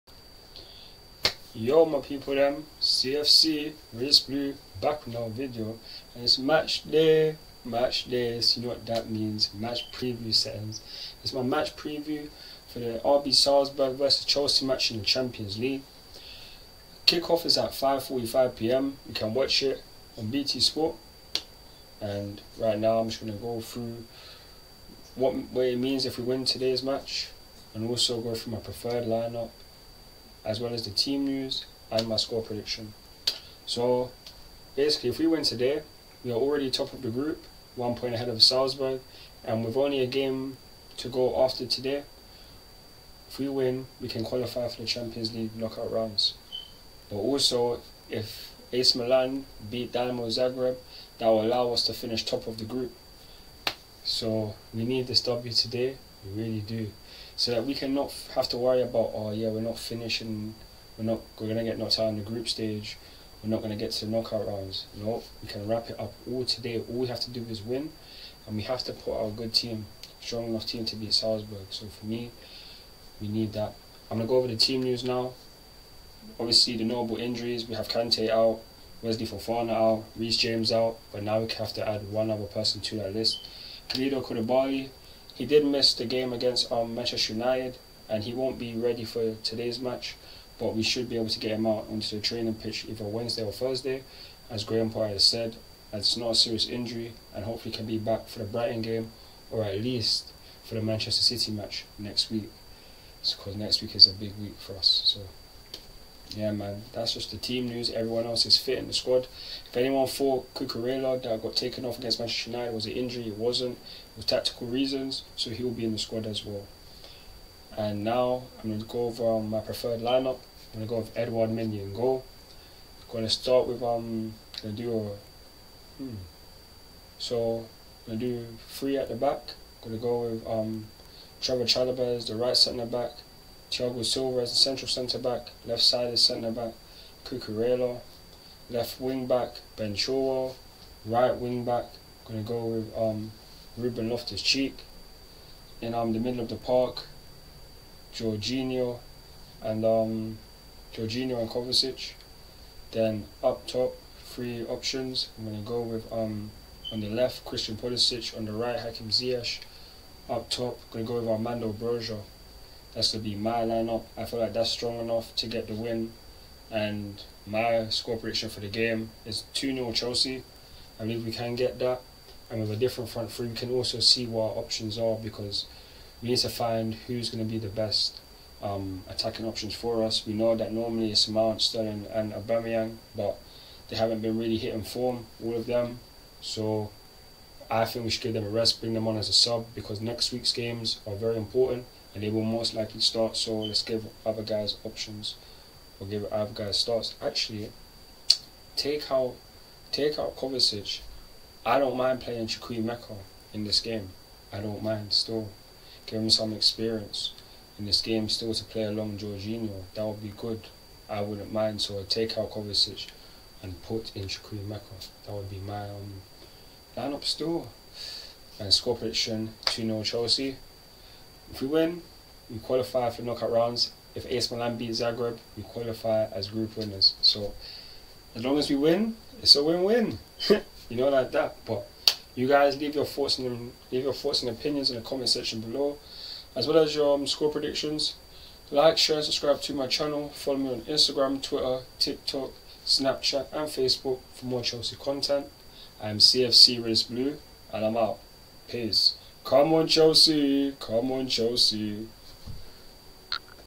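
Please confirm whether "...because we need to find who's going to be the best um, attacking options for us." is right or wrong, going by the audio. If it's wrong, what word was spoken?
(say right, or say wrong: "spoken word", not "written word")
right.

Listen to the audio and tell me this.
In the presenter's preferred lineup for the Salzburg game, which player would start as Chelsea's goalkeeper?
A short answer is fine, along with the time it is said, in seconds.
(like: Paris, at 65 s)
Edward Mendy, at 121 s.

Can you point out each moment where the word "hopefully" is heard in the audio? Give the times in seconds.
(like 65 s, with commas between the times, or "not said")
97 s.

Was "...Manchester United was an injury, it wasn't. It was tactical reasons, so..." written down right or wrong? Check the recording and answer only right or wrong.
right.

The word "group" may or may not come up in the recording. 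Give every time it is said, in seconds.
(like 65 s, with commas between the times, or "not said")
37 s, 52 s, 62 s, 226 s.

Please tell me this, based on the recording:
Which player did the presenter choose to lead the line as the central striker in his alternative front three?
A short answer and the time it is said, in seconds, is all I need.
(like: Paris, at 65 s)
Armando Broja, at 161 s.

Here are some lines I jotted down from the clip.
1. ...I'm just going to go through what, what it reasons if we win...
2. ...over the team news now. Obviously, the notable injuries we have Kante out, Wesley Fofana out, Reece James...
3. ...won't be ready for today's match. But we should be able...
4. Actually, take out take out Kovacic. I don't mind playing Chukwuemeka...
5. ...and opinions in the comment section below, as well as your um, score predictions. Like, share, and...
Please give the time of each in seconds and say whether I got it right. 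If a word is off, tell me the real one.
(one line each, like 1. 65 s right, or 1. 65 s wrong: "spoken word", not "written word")
1. 22 s wrong: "means", not "reasons"
2. 74 s right
3. 88 s right
4. 197 s right
5. 234 s right.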